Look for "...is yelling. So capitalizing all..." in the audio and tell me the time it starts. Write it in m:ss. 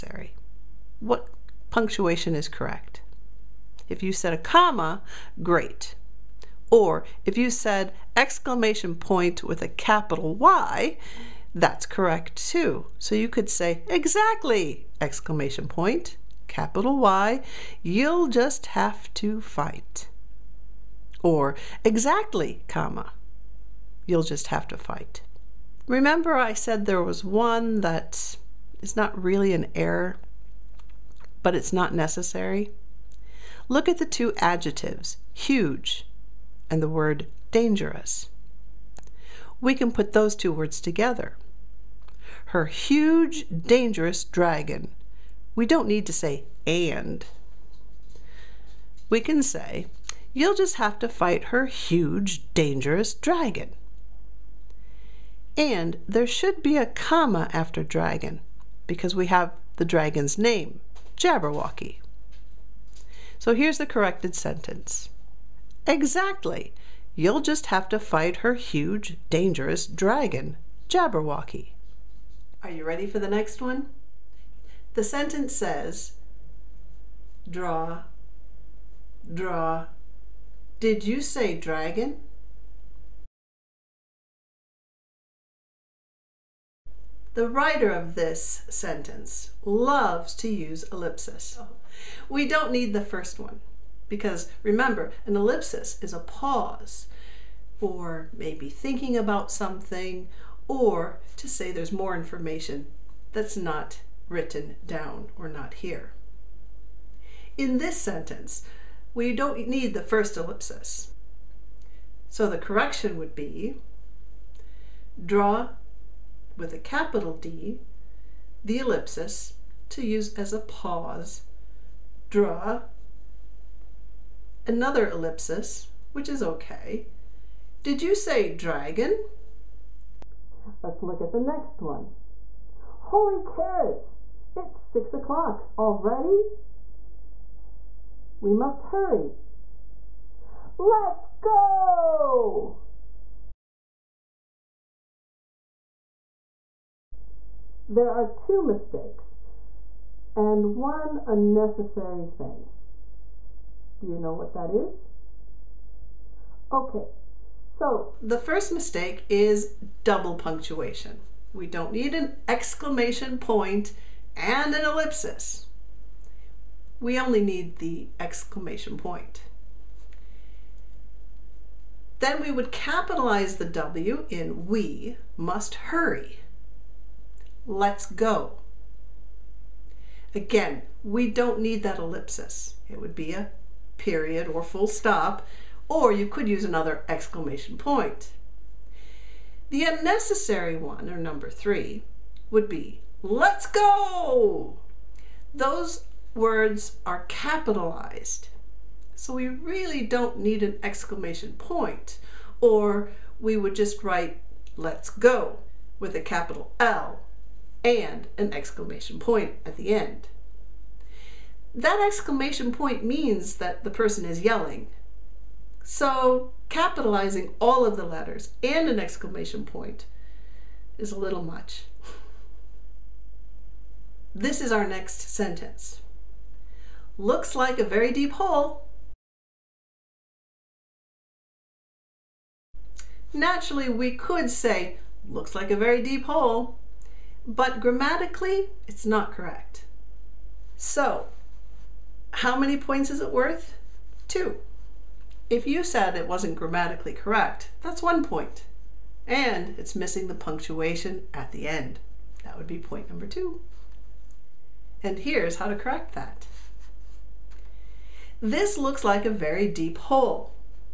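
3:34.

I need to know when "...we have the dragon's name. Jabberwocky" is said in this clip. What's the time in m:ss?
0:59.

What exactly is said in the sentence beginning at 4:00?
So, how many points is it worth?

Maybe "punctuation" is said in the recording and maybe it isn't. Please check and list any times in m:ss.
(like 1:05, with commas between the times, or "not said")
0:01, 2:40, 4:10.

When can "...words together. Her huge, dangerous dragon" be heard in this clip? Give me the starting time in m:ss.
0:40.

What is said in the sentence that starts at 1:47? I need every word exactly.
In this sentence, we don't need the first ellipsis.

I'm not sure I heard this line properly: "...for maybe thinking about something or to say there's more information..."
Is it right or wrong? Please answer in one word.
right.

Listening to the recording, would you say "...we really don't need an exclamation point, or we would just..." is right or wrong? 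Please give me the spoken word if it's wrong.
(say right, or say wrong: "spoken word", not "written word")
right.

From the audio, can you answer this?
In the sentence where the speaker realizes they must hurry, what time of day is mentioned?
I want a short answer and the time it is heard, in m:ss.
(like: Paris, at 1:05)
6 o'clock, at 2:14.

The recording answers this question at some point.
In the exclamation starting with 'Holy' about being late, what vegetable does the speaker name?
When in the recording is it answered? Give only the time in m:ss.
2:13.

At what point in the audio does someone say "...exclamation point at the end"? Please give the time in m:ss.
3:28.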